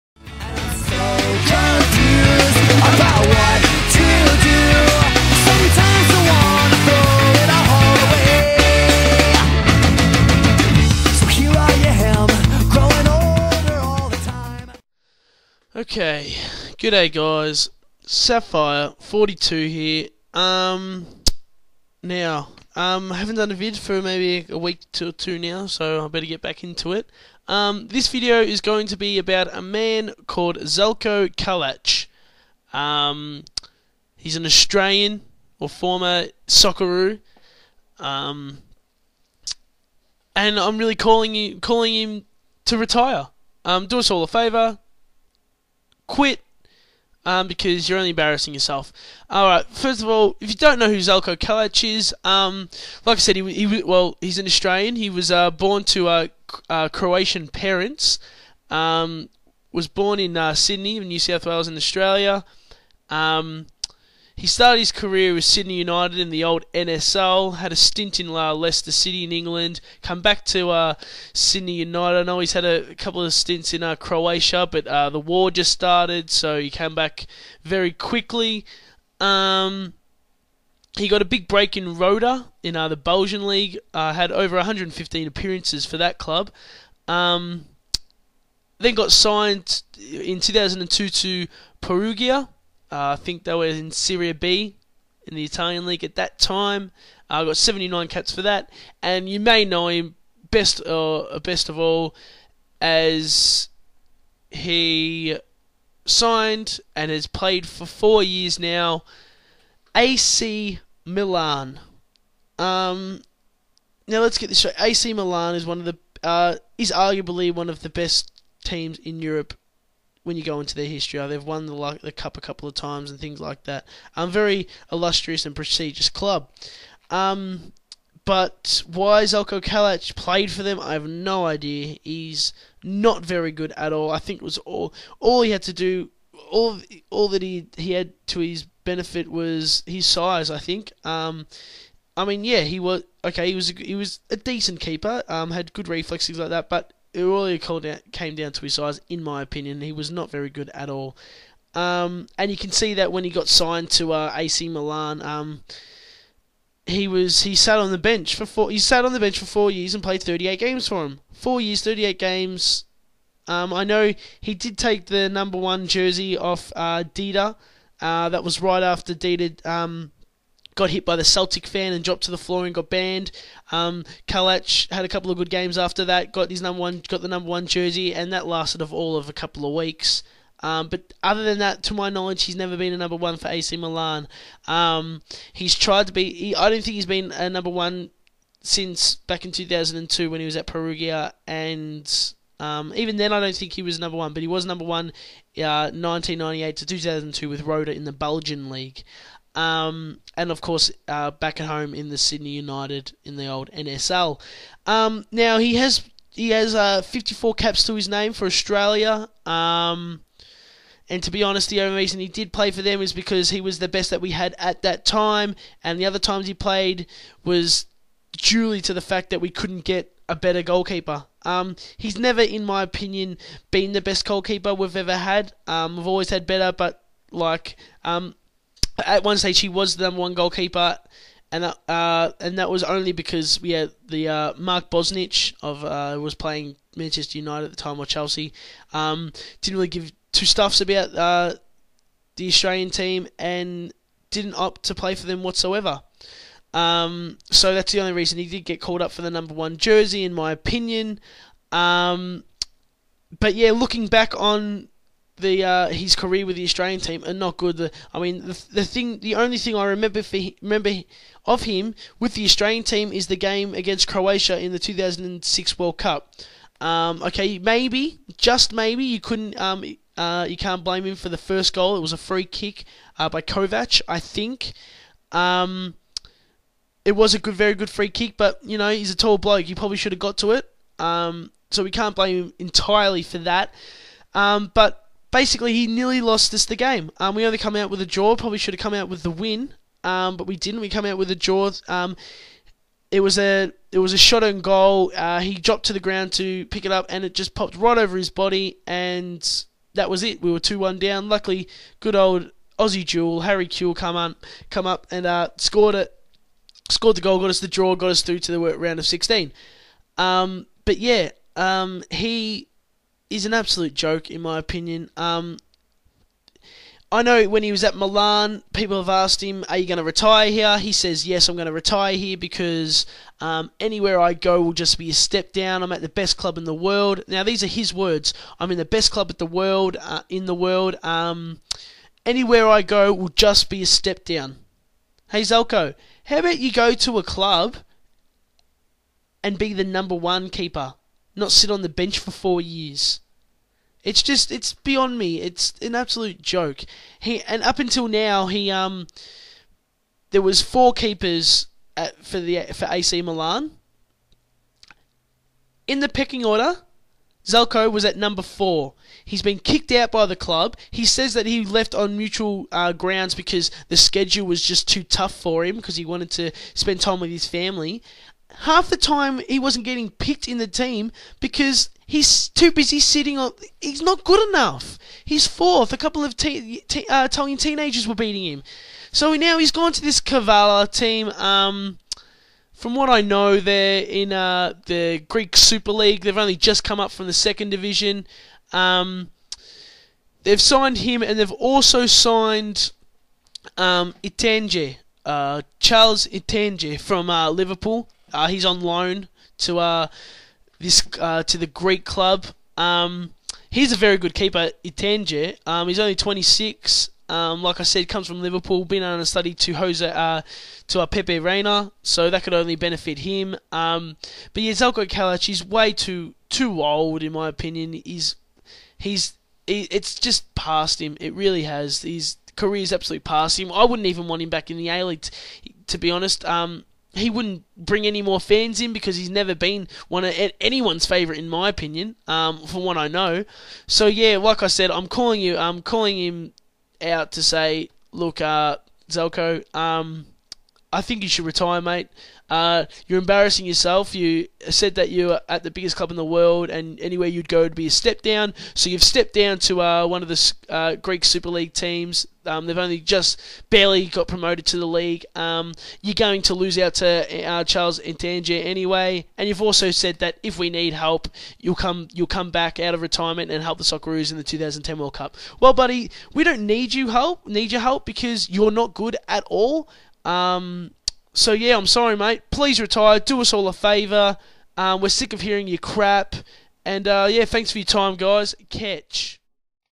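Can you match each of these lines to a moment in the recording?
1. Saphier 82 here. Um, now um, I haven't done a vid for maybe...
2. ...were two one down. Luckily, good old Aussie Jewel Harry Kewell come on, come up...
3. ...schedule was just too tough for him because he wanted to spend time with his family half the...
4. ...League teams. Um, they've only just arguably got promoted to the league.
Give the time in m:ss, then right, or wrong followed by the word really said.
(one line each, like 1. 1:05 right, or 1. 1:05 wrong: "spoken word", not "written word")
1. 0:18 wrong: "42", not "82"
2. 5:00 right
3. 6:03 right
4. 7:31 wrong: "barely", not "arguably".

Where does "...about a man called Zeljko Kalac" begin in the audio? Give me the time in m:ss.
0:29.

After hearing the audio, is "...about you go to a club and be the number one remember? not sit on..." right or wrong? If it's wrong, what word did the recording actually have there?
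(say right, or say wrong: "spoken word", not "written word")
wrong: "keeper", not "remember".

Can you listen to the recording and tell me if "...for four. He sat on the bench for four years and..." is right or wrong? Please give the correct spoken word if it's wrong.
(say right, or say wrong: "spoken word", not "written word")
right.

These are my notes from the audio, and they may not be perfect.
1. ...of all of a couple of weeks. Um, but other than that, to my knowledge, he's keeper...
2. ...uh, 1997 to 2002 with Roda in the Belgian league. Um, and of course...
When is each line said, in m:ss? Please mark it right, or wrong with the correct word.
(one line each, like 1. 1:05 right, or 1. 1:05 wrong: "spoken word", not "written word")
1. 2:58 wrong: "never", not "keeper"
2. 3:15 wrong: "1998", not "1997".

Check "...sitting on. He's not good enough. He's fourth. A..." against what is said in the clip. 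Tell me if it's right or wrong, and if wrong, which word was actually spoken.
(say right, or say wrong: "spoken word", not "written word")
right.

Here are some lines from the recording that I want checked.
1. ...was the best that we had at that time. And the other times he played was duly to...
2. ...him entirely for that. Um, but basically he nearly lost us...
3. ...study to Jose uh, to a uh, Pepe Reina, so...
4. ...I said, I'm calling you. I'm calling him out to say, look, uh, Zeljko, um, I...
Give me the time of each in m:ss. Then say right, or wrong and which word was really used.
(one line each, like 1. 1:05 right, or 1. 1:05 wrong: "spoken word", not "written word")
1. 3:33 right
2. 4:42 right
3. 6:49 right
4. 7:14 right.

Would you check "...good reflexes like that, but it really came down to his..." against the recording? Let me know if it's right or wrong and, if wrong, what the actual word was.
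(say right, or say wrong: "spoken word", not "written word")
right.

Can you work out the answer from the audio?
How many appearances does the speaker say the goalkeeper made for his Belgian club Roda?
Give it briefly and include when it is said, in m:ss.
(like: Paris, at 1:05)
over 115, at 1:24.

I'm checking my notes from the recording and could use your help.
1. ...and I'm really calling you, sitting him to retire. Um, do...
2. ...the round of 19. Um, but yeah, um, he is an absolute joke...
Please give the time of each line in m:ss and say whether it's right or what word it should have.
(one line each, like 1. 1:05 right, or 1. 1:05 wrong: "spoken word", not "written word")
1. 0:40 wrong: "calling", not "sitting"
2. 5:08 wrong: "16", not "19".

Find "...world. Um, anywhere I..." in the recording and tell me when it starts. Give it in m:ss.
5:30.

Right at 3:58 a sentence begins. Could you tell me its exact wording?
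Um, didn't really give two stuffs about uh, the Australian team and didn't opt to play for them whatsoever.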